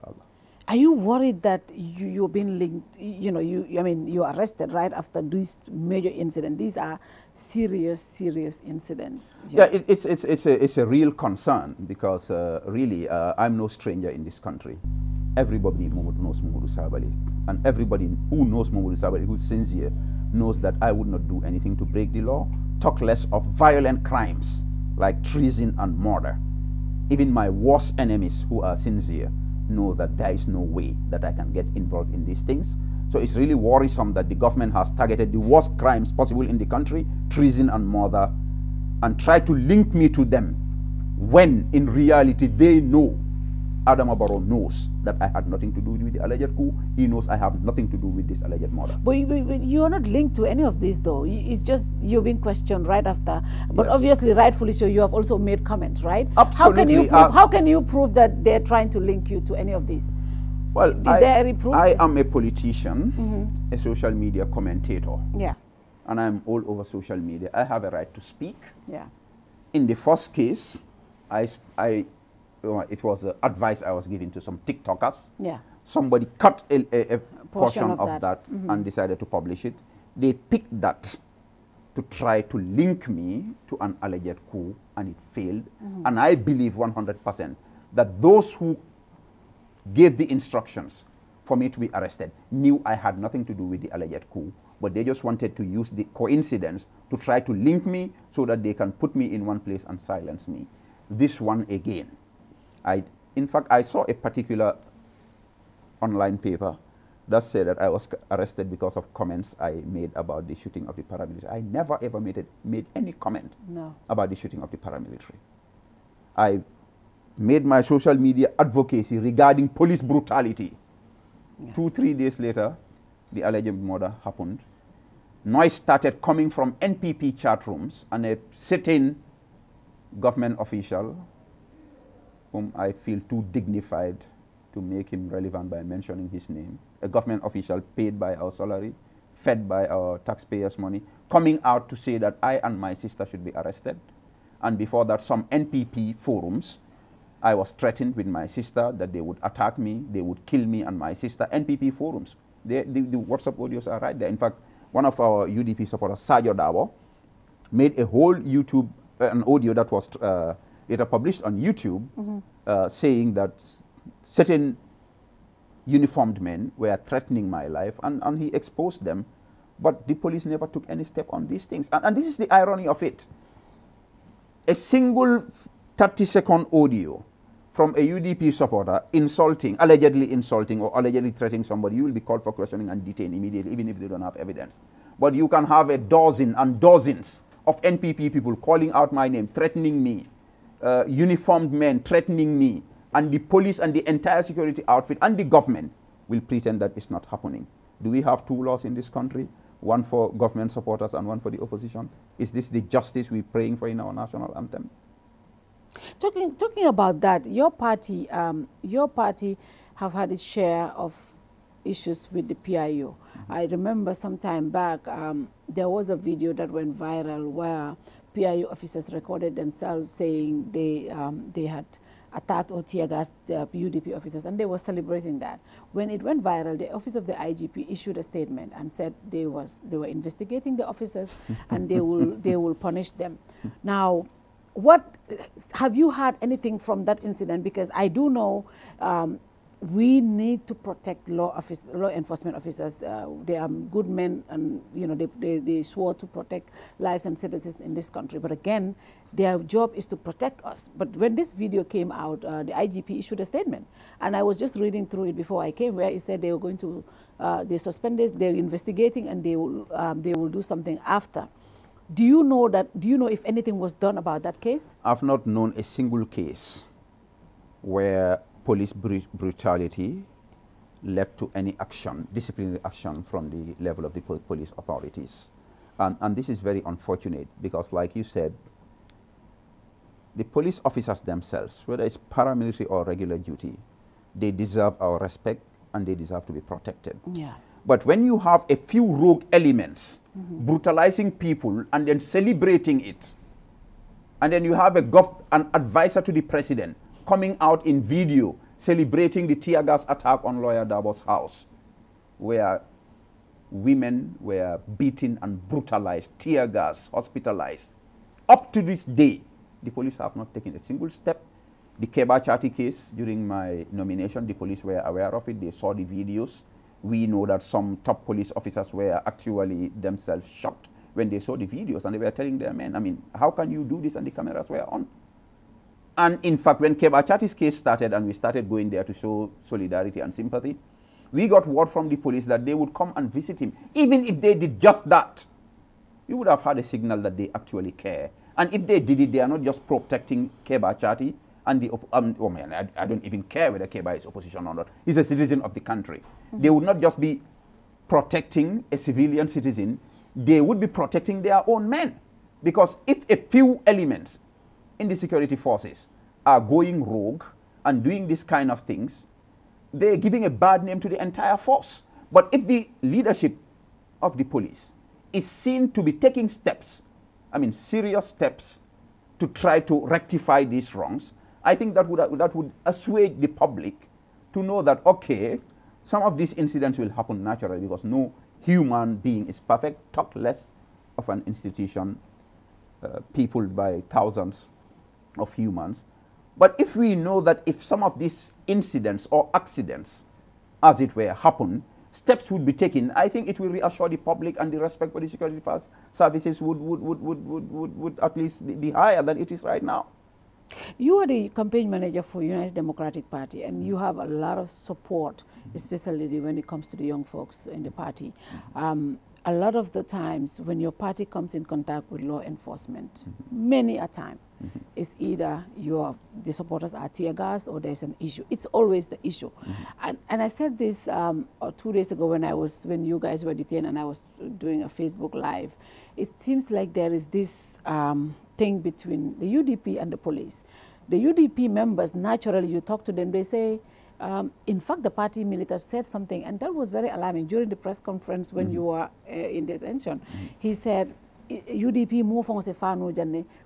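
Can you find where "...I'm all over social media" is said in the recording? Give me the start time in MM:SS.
01:06.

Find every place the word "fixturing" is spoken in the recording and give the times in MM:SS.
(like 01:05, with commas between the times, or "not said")
not said.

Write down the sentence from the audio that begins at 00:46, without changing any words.
He knows I have nothing to do with this alleged murder.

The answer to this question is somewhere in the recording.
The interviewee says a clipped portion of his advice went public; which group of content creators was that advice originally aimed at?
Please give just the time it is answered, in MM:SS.
01:14.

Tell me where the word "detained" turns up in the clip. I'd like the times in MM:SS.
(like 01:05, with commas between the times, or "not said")
03:03, 07:03.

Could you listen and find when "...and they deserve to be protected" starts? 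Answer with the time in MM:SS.
04:45.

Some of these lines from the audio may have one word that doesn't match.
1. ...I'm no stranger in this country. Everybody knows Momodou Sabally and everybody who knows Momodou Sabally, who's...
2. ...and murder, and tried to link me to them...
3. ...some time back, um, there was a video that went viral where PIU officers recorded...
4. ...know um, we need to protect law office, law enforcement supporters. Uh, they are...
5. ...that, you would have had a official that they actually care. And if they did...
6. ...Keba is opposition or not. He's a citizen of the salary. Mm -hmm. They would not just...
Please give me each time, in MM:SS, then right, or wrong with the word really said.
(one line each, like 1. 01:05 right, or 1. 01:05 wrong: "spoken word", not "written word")
1. 00:13 right
2. 00:37 right
3. 03:34 right
4. 03:58 wrong: "officers", not "supporters"
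5. 05:35 wrong: "signal", not "official"
6. 05:43 wrong: "country", not "salary".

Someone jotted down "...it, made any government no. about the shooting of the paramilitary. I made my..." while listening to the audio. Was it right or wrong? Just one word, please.
wrong.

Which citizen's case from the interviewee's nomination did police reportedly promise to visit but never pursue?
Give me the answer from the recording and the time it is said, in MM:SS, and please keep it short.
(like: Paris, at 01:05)
Keba Chati, at 05:12.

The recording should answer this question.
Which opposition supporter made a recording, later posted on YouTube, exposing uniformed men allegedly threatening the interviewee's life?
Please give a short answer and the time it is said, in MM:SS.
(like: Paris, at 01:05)
Sajo Dawo, at 02:36.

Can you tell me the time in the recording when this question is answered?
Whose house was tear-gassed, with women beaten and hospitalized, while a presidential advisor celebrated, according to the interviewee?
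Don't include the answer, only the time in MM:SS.
05:00.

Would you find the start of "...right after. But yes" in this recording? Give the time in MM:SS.
00:52.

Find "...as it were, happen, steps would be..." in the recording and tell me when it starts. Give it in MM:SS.
06:30.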